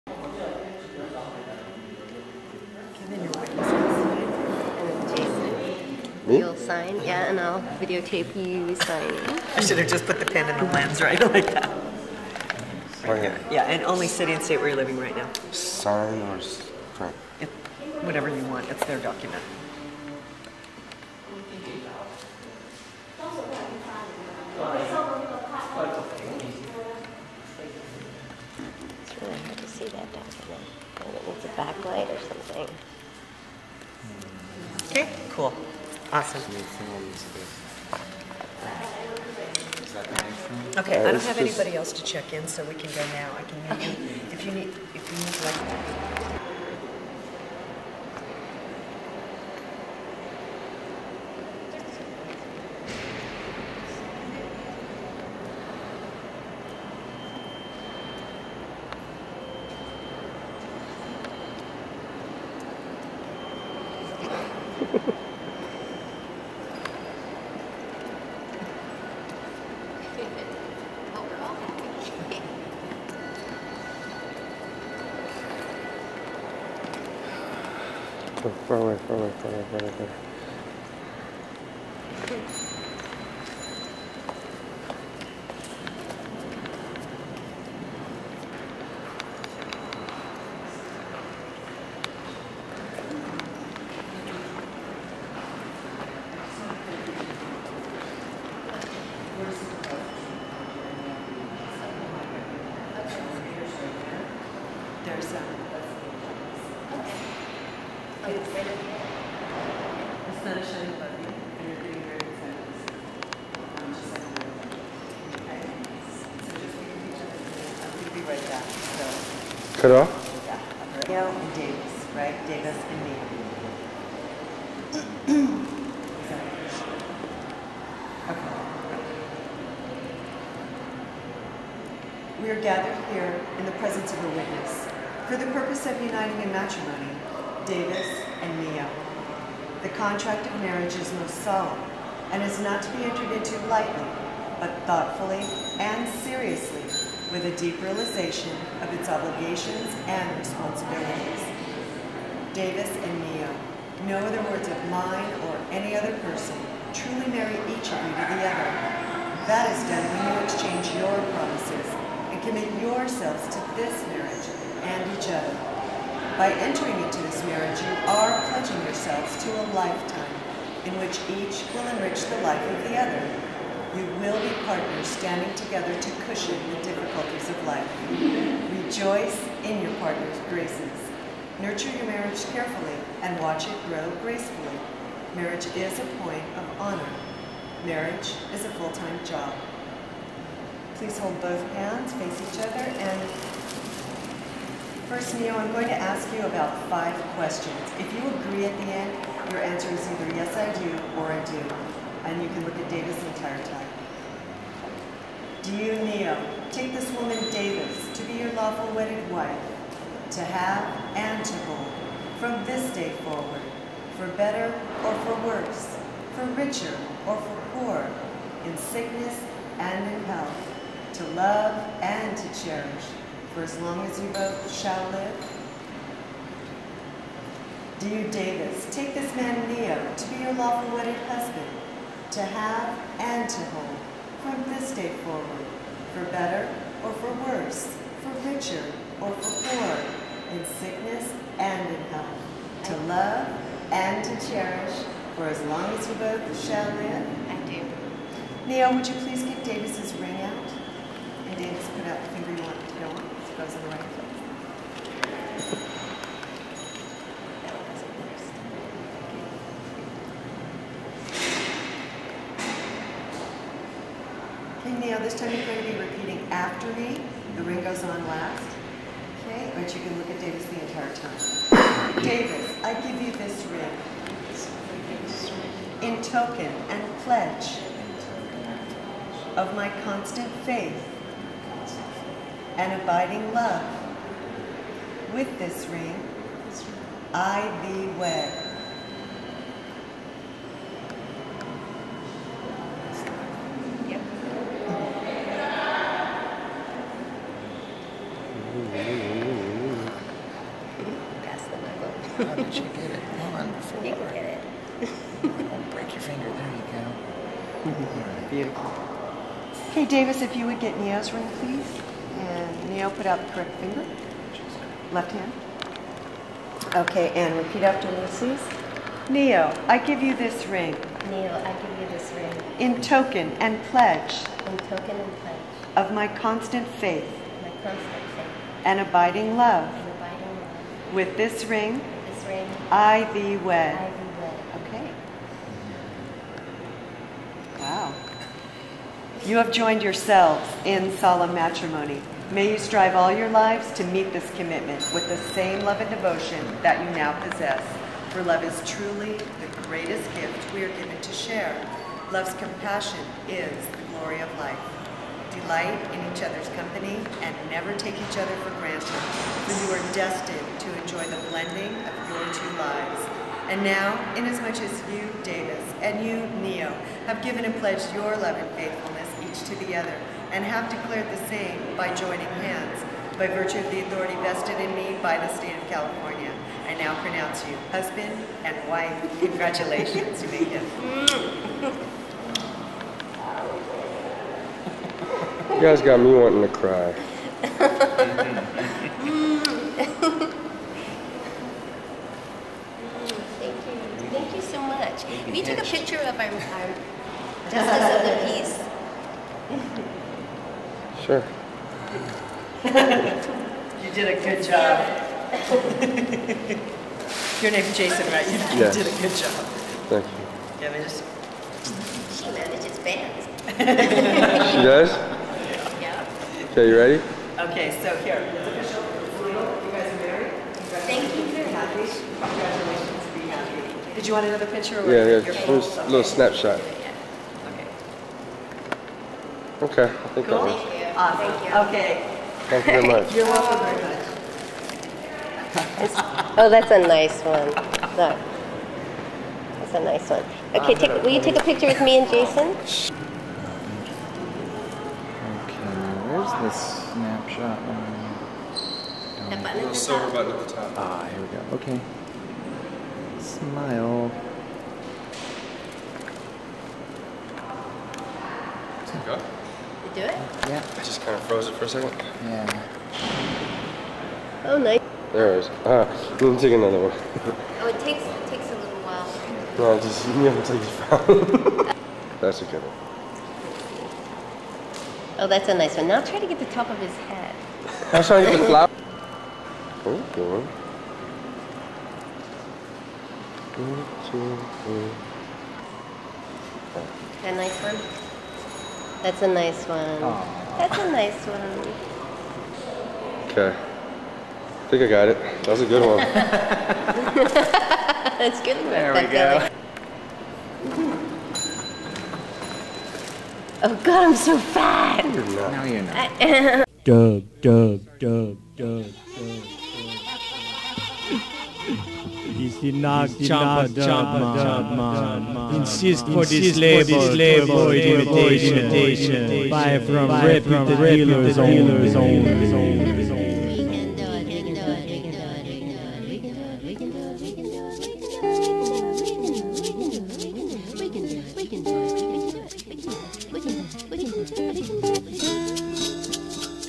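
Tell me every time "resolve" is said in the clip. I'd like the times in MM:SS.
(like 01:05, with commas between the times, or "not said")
not said.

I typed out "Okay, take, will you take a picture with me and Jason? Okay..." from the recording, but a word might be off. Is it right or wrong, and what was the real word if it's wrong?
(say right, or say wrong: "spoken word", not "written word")
right.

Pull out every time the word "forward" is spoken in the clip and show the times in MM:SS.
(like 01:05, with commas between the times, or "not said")
03:33, 03:55.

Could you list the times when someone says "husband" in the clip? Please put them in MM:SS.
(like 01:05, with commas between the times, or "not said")
03:51, 06:17.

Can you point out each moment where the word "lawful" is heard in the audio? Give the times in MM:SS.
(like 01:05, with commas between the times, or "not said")
03:28, 03:50.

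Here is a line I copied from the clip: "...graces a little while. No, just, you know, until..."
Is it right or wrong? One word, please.
wrong.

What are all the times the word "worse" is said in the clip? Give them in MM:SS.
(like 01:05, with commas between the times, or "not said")
03:35, 03:57.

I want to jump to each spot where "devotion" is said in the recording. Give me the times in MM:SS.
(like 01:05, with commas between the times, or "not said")
05:46.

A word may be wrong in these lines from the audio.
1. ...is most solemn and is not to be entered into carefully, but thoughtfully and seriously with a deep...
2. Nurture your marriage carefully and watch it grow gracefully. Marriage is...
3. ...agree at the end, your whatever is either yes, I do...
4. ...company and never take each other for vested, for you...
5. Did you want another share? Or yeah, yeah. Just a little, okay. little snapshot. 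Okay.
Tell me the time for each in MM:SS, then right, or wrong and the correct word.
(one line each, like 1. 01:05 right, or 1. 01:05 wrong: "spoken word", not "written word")
1. 02:20 wrong: "lightly", not "carefully"
2. 03:01 right
3. 03:18 wrong: "answer", not "whatever"
4. 05:56 wrong: "granted", not "vested"
5. 07:04 wrong: "picture", not "share".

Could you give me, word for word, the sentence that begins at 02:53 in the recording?
You will be partners standing together to cushion the difficulties of life.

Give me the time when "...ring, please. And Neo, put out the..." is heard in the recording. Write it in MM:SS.
05:11.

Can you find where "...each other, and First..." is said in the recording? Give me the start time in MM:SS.
03:12.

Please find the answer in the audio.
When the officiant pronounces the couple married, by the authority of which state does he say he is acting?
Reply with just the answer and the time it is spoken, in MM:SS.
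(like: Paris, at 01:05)
California, at 06:15.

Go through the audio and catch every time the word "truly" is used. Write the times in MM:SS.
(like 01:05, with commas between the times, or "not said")
02:36, 05:48.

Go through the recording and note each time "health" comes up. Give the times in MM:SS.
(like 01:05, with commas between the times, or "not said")
03:40, 04:02.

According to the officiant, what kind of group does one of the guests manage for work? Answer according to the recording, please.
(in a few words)
Manages bands.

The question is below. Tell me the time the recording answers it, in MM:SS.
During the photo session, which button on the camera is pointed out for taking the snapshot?
07:29.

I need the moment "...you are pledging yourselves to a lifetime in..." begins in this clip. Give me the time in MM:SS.
02:47.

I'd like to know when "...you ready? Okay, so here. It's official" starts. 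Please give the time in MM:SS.
06:56.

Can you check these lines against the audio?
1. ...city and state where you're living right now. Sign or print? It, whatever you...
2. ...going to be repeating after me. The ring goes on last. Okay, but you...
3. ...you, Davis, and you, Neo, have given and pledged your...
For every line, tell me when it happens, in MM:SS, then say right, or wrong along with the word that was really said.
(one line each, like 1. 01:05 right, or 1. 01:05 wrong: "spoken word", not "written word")
1. 00:14 right
2. 04:25 right
3. 06:05 right.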